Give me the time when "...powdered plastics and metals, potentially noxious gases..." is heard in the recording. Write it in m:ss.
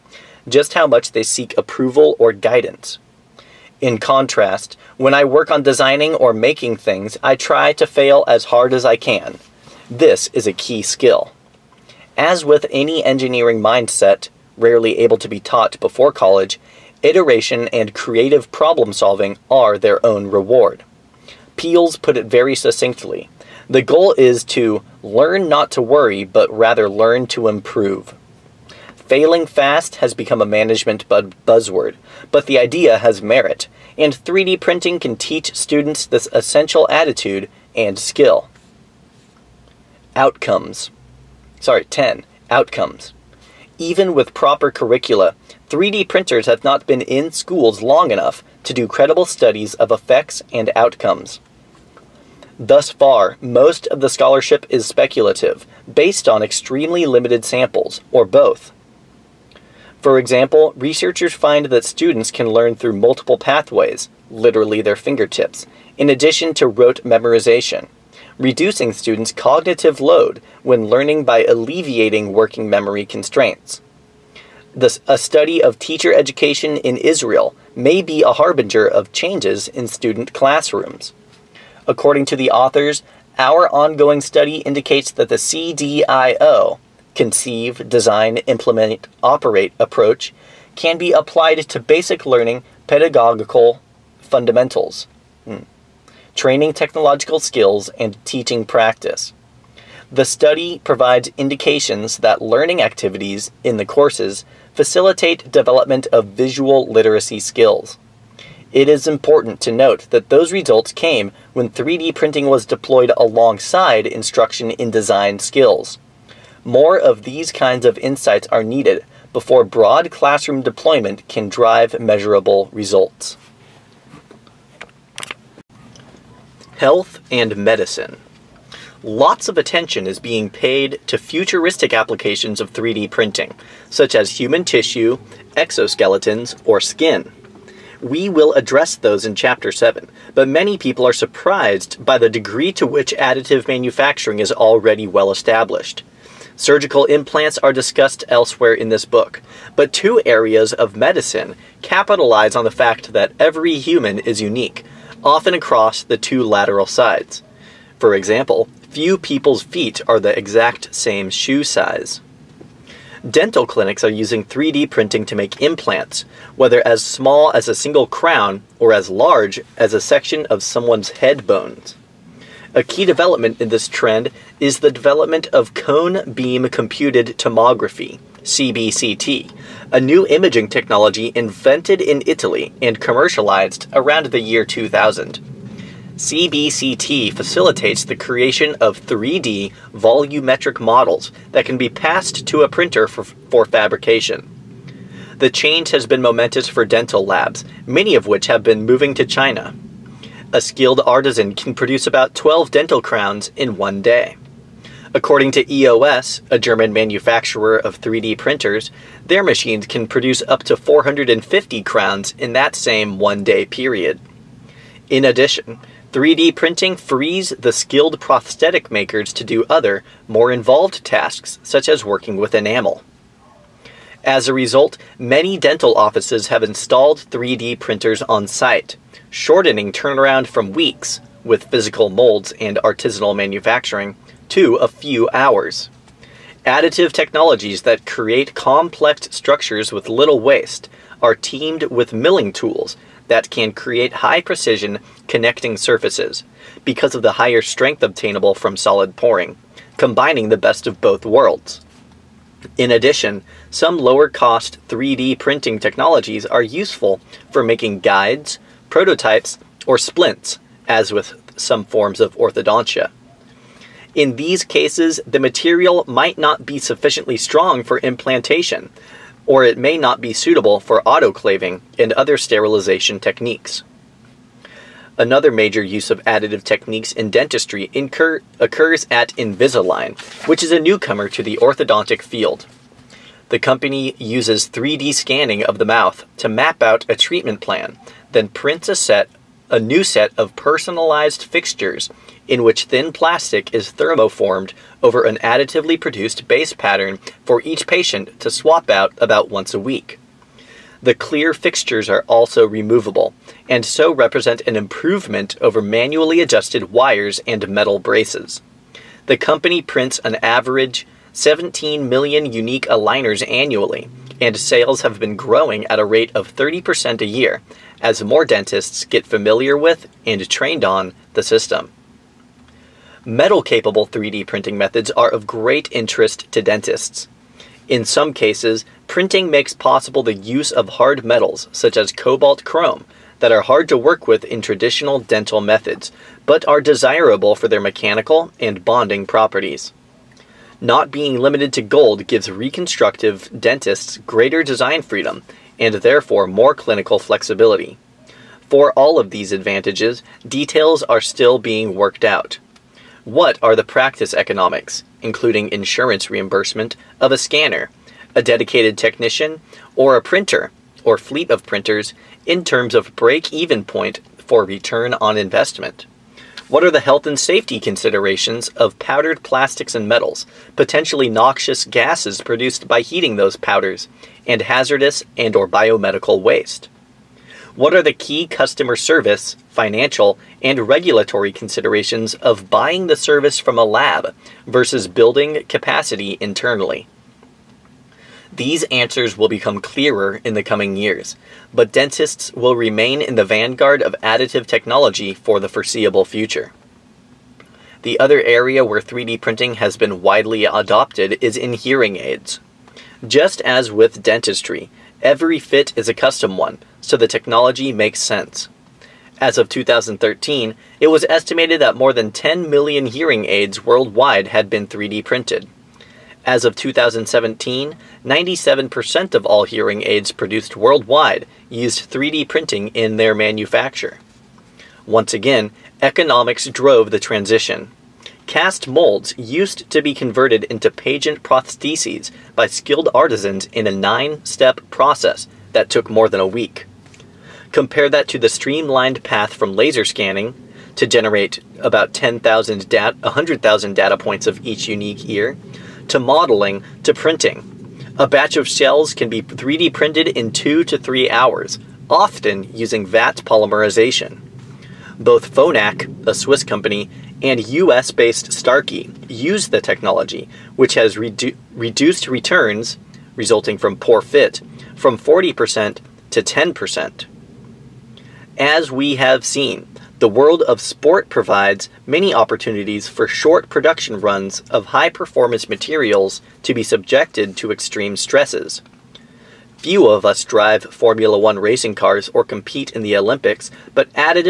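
6:08.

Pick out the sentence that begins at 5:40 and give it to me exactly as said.
Not being limited to gold gives reconstructive dentists greater design freedom and therefore more clinical flexibility.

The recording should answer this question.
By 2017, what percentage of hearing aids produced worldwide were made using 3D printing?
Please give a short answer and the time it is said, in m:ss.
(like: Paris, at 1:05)
97%, at 6:58.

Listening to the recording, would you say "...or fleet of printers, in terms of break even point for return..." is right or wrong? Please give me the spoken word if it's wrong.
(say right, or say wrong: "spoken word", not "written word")
right.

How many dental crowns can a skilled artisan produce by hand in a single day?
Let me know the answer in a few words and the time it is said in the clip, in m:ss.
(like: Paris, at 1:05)
12, at 3:22.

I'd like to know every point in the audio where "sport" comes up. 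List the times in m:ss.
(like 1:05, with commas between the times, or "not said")
7:50.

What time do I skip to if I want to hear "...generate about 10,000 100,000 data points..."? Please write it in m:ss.
7:21.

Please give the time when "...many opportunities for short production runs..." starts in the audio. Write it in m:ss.
7:52.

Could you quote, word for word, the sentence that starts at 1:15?
a study of teacher education in Israel may be a harbinger of changes in student classrooms.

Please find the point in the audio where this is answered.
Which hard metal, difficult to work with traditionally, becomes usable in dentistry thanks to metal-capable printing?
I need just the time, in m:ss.
5:32.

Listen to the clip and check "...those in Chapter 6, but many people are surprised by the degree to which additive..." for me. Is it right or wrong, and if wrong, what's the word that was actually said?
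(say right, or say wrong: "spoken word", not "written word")
wrong: "7", not "6".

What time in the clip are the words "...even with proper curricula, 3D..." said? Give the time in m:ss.
0:43.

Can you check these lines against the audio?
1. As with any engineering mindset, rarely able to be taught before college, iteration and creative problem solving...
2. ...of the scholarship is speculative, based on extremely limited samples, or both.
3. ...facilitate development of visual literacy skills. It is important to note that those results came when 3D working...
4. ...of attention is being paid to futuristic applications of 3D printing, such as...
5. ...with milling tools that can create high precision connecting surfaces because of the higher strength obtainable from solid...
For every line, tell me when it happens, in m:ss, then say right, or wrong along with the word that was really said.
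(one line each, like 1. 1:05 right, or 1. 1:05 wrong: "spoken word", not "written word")
1. 0:12 right
2. 0:53 right
3. 1:44 wrong: "printing", not "working"
4. 2:09 right
5. 4:01 right.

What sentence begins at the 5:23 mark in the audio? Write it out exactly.
Metal capable 3D printing methods are of great interest to dentists.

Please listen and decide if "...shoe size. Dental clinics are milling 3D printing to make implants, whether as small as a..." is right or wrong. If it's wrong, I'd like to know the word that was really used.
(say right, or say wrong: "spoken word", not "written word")
wrong: "using", not "milling".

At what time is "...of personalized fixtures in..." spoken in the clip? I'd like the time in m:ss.
4:50.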